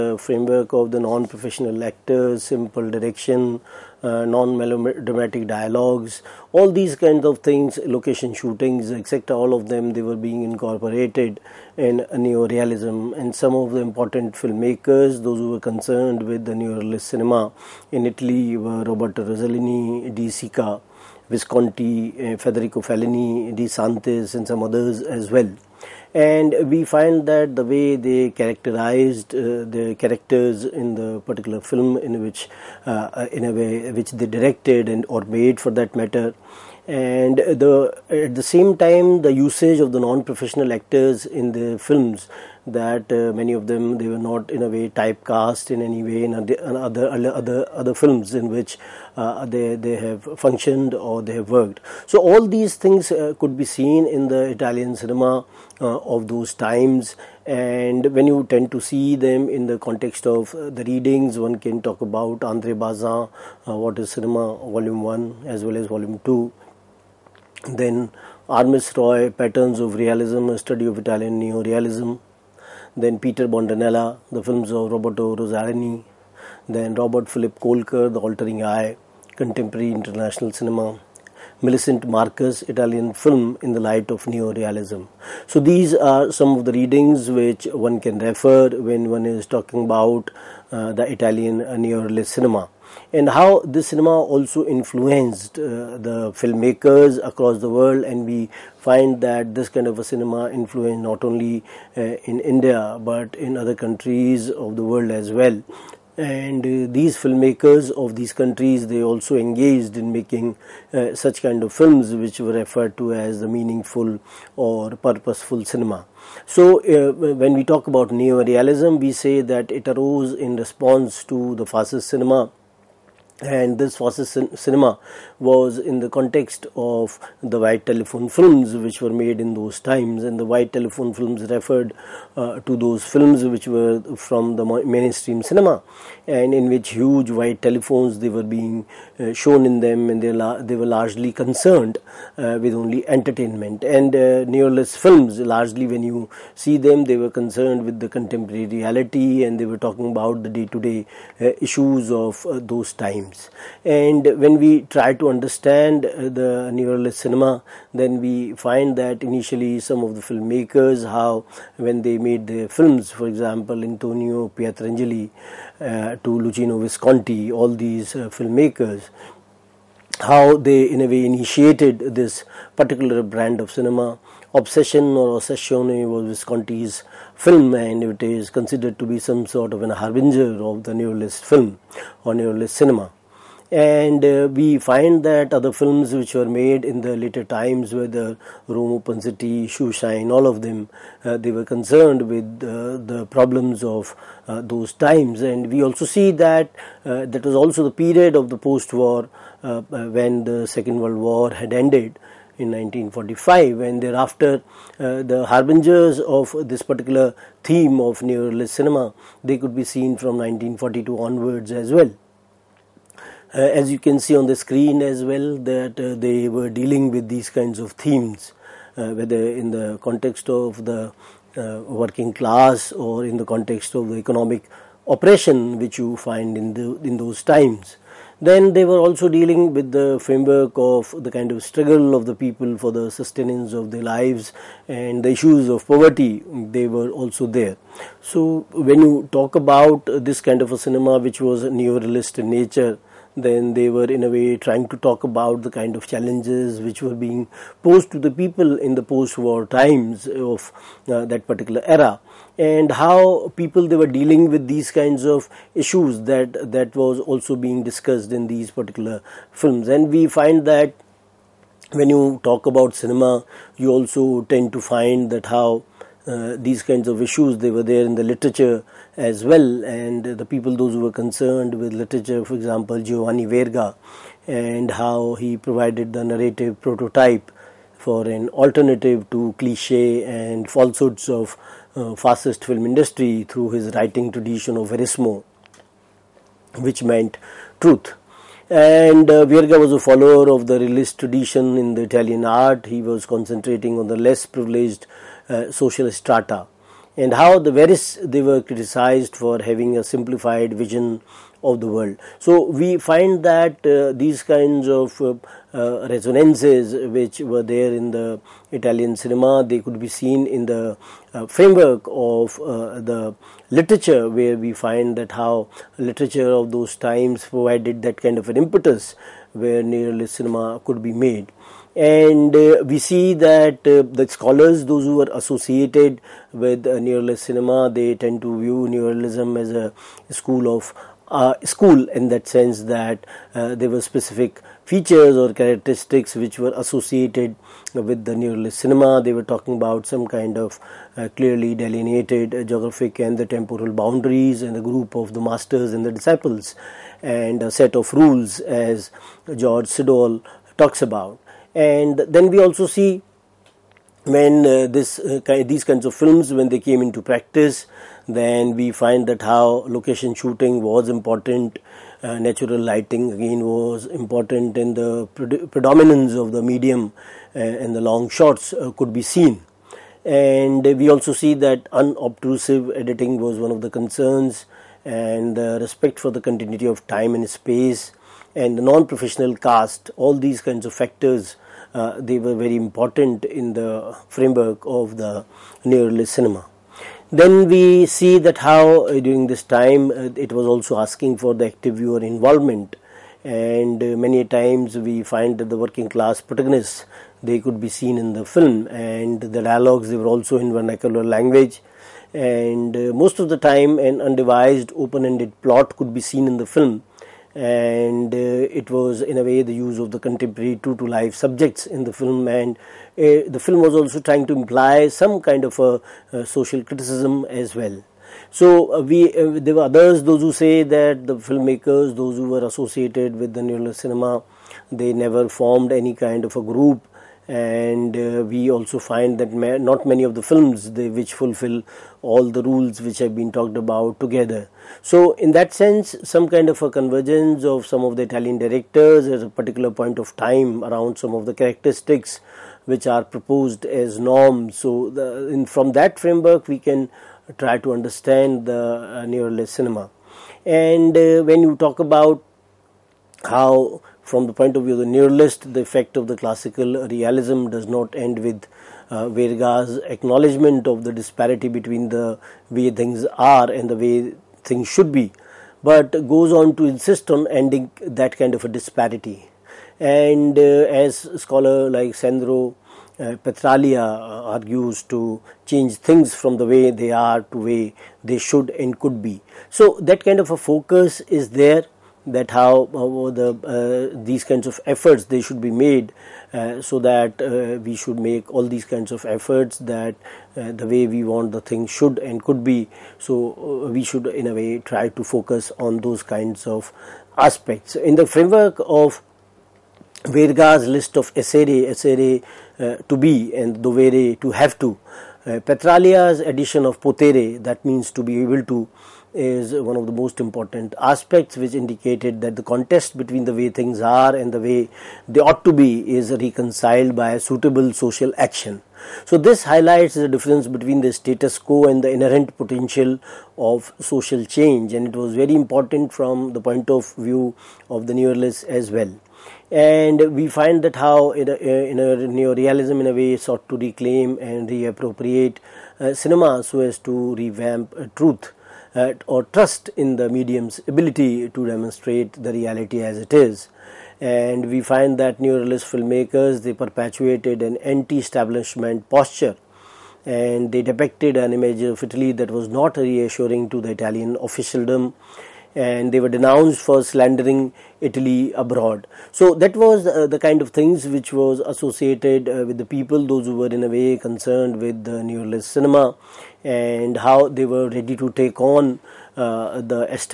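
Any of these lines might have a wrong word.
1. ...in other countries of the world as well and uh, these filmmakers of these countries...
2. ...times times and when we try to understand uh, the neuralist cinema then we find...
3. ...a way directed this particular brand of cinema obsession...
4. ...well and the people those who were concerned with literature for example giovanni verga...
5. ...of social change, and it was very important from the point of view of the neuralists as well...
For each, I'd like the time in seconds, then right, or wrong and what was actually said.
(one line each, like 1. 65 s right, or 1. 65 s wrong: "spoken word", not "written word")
1. 103 s right
2. 152 s right
3. 171 s wrong: "initiated", not "directed"
4. 269 s right
5. 523 s right.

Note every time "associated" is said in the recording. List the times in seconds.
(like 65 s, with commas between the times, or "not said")
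325 s, 336 s, 422 s, 561 s.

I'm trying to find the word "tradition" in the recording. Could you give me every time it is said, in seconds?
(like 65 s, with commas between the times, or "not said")
284 s, 291 s.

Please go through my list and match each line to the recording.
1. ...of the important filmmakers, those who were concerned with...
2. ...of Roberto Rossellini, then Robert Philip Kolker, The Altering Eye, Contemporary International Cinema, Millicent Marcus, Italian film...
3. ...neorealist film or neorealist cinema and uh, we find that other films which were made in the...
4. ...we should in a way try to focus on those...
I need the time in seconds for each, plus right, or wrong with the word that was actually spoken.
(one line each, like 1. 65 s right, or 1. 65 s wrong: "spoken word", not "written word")
1. 13 s right
2. 74 s right
3. 181 s right
4. 493 s right.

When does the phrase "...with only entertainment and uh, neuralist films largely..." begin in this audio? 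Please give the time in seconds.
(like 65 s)
142 s.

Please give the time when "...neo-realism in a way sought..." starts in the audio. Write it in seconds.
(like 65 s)
532 s.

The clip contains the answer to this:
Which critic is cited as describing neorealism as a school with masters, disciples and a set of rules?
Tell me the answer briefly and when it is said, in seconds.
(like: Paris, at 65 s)
George Sadoul, at 349 s.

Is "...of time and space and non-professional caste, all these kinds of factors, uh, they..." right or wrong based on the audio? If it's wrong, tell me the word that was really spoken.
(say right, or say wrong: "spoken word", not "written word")
right.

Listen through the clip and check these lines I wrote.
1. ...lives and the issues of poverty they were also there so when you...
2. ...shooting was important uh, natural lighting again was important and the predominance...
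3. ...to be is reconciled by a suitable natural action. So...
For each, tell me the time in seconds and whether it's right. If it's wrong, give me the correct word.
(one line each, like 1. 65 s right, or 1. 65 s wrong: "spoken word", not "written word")
1. 234 s right
2. 360 s right
3. 515 s wrong: "social", not "natural".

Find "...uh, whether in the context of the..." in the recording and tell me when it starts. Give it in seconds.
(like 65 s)
218 s.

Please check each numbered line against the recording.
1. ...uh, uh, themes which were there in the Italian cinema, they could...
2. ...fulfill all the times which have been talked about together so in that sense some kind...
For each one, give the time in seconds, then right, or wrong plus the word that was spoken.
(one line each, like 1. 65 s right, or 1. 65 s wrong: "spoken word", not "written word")
1. 305 s wrong: "resonances", not "themes"
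2. 431 s wrong: "rules", not "times".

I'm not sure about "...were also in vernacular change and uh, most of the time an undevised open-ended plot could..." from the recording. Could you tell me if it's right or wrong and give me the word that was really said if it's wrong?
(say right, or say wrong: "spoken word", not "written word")
wrong: "language", not "change".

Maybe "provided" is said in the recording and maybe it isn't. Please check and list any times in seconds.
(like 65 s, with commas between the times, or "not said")
275 s, 317 s.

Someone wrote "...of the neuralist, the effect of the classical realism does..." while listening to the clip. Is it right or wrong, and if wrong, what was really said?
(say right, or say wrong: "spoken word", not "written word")
right.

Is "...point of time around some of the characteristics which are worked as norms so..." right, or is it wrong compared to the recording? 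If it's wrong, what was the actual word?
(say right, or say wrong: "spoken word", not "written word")
wrong: "proposed", not "worked".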